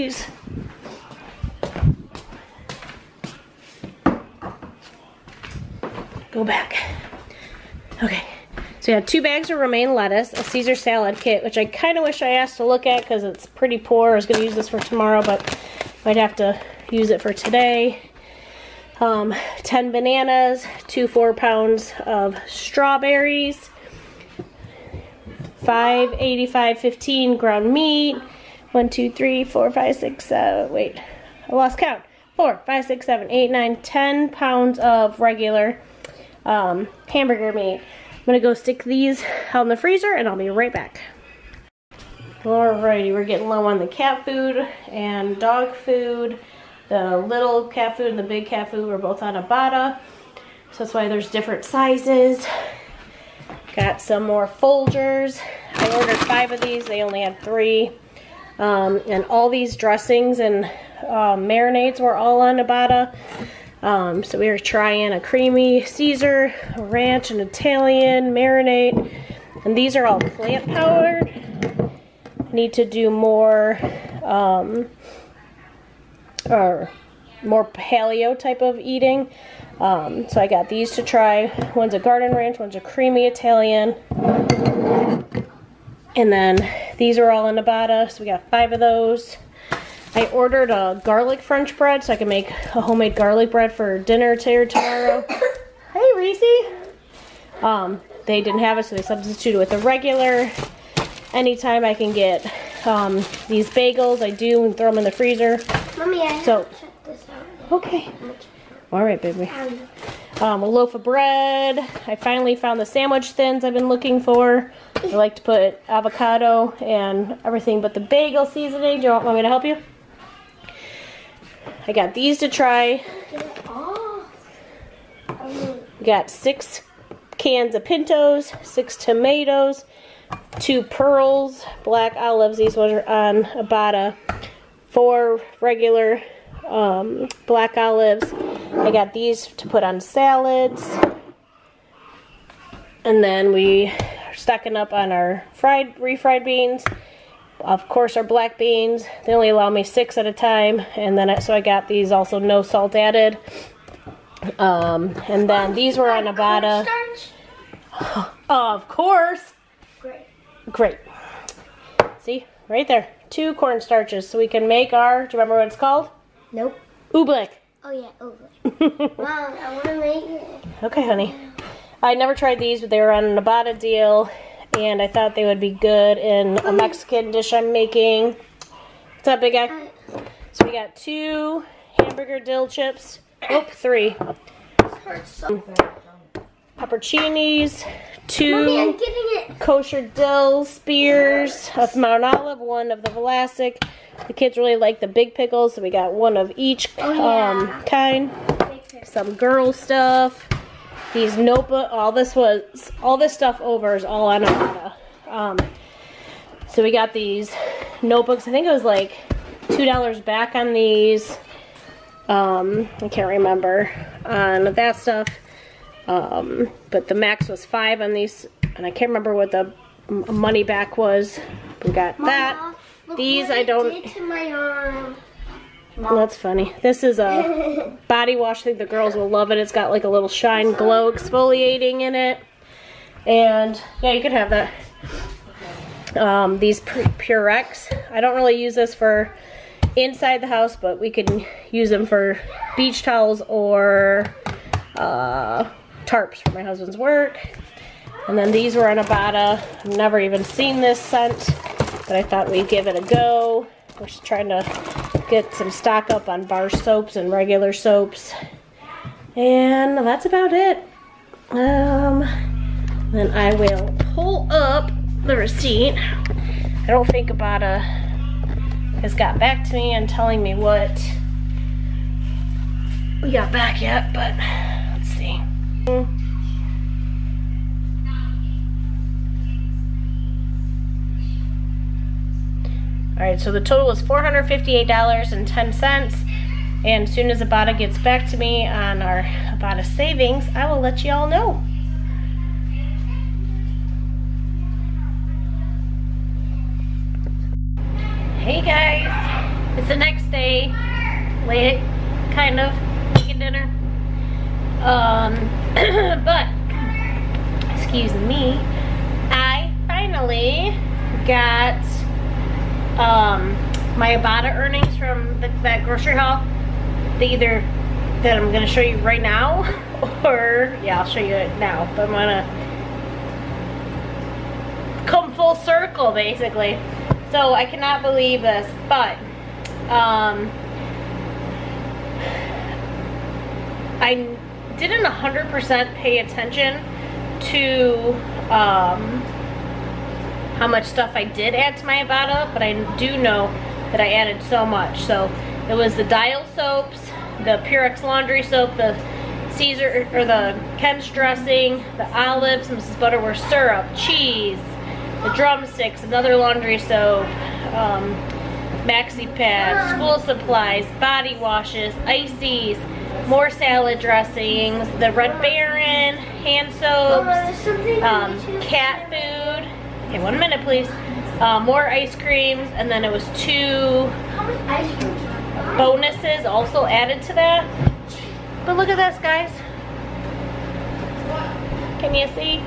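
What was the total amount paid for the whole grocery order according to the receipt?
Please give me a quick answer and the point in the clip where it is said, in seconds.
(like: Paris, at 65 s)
$458.10, at 284 s.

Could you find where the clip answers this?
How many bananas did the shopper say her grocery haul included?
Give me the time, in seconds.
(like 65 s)
19 s.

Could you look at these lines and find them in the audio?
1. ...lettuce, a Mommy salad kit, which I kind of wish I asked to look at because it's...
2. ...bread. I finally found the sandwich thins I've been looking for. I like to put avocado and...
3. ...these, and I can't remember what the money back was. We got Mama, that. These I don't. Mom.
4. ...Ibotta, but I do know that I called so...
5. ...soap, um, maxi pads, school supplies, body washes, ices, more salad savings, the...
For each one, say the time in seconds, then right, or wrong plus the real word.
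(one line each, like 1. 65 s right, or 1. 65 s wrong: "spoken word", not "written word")
1. 9 s wrong: "Caesar", not "Mommy"
2. 111 s right
3. 218 s right
4. 342 s wrong: "added", not "called"
5. 356 s wrong: "dressings", not "savings".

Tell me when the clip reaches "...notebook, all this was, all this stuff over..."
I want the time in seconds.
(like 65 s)
201 s.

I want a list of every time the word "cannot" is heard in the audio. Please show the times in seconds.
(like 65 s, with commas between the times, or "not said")
327 s.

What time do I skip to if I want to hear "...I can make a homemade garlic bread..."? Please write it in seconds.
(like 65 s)
92 s.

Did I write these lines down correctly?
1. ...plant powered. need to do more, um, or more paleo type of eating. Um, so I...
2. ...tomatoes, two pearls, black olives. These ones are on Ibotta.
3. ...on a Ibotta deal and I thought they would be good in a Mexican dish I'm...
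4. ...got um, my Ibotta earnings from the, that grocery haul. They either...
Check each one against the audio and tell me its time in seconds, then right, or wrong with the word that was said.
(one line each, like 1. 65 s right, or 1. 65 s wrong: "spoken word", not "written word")
1. 70 s right
2. 128 s right
3. 173 s right
4. 311 s right.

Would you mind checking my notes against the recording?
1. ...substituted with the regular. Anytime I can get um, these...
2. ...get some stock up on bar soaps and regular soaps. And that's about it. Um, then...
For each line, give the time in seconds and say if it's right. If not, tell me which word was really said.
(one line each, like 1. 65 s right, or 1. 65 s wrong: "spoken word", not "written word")
1. 99 s right
2. 255 s right.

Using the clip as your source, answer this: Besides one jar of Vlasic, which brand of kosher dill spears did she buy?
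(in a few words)
Mount Olive.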